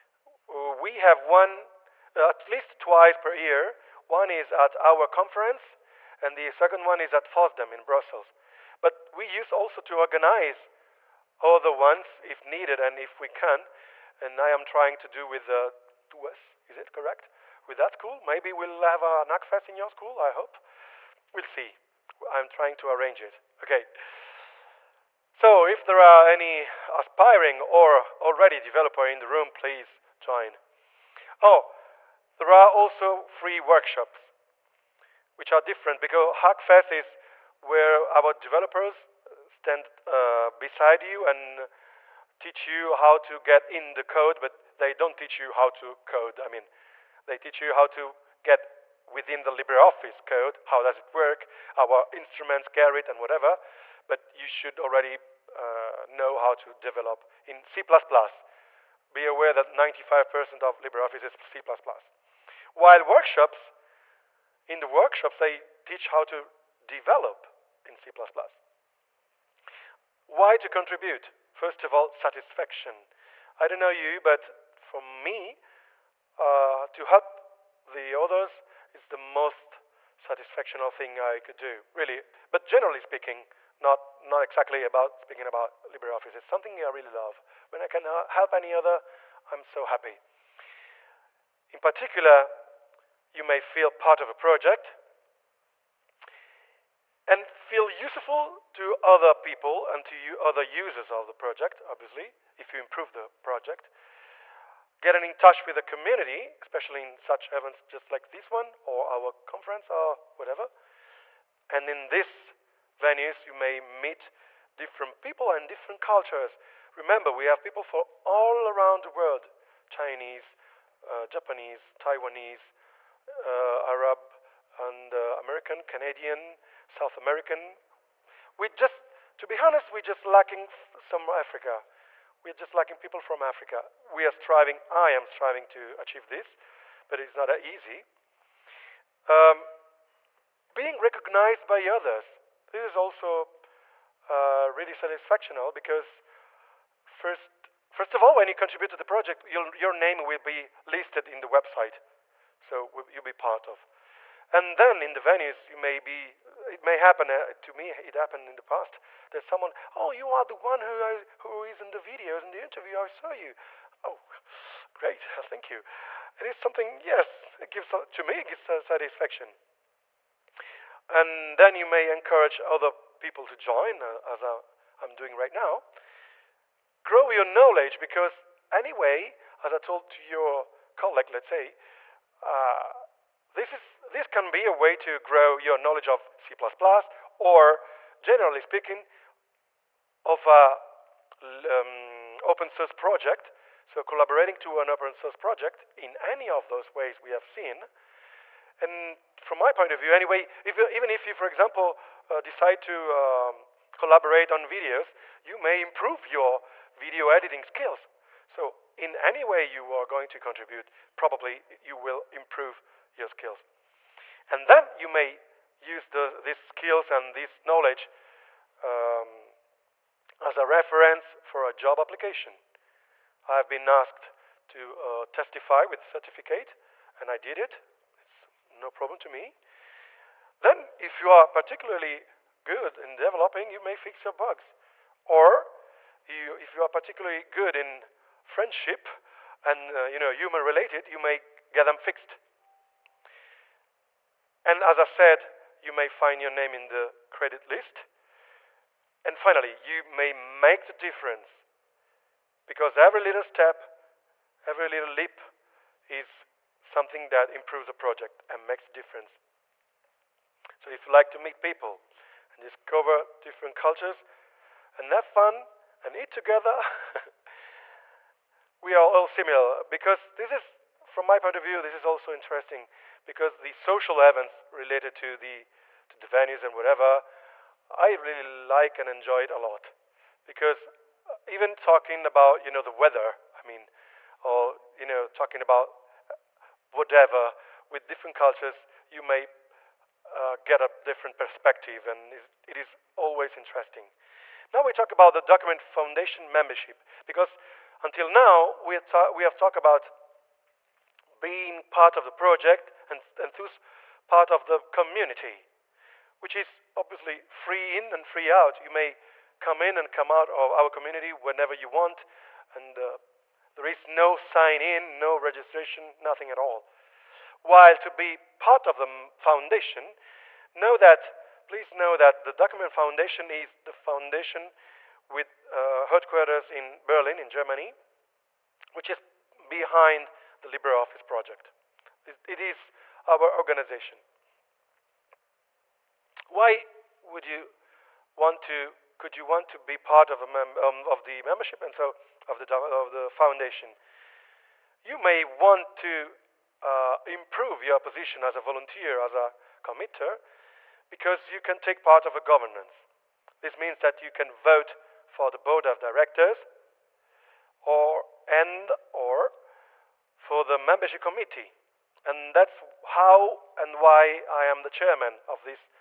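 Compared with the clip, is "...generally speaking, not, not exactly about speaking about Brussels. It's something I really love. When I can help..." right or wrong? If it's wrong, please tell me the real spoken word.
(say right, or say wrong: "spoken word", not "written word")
wrong: "LibreOffice", not "Brussels".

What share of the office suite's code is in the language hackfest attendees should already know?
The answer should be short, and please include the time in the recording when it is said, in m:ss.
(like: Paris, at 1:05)
95%, at 0:59.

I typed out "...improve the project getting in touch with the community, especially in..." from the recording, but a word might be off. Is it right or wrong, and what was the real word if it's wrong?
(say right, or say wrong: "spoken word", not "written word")
right.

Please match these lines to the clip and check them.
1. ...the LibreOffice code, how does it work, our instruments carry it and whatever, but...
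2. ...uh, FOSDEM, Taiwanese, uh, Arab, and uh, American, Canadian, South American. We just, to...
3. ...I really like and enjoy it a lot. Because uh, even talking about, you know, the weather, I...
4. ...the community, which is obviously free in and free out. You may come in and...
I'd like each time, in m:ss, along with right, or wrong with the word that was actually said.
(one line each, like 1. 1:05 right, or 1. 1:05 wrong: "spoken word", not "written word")
1. 0:49 right
2. 2:01 wrong: "Japanese", not "FOSDEM"
3. 4:37 right
4. 5:04 right.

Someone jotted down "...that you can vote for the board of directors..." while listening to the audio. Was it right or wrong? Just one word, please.
right.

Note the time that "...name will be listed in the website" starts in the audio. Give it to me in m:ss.
2:29.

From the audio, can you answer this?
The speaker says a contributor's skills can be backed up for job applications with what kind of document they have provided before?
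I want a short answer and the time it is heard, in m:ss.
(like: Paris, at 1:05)
certificate, at 3:46.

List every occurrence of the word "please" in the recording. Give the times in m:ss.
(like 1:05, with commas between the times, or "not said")
0:29, 5:21.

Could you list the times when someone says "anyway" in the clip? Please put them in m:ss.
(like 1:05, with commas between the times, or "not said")
2:58, 3:20.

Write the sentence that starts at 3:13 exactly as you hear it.
So collaborating to an open source project in any of those ways we have seen.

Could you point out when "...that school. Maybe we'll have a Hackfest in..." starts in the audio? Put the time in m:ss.
0:17.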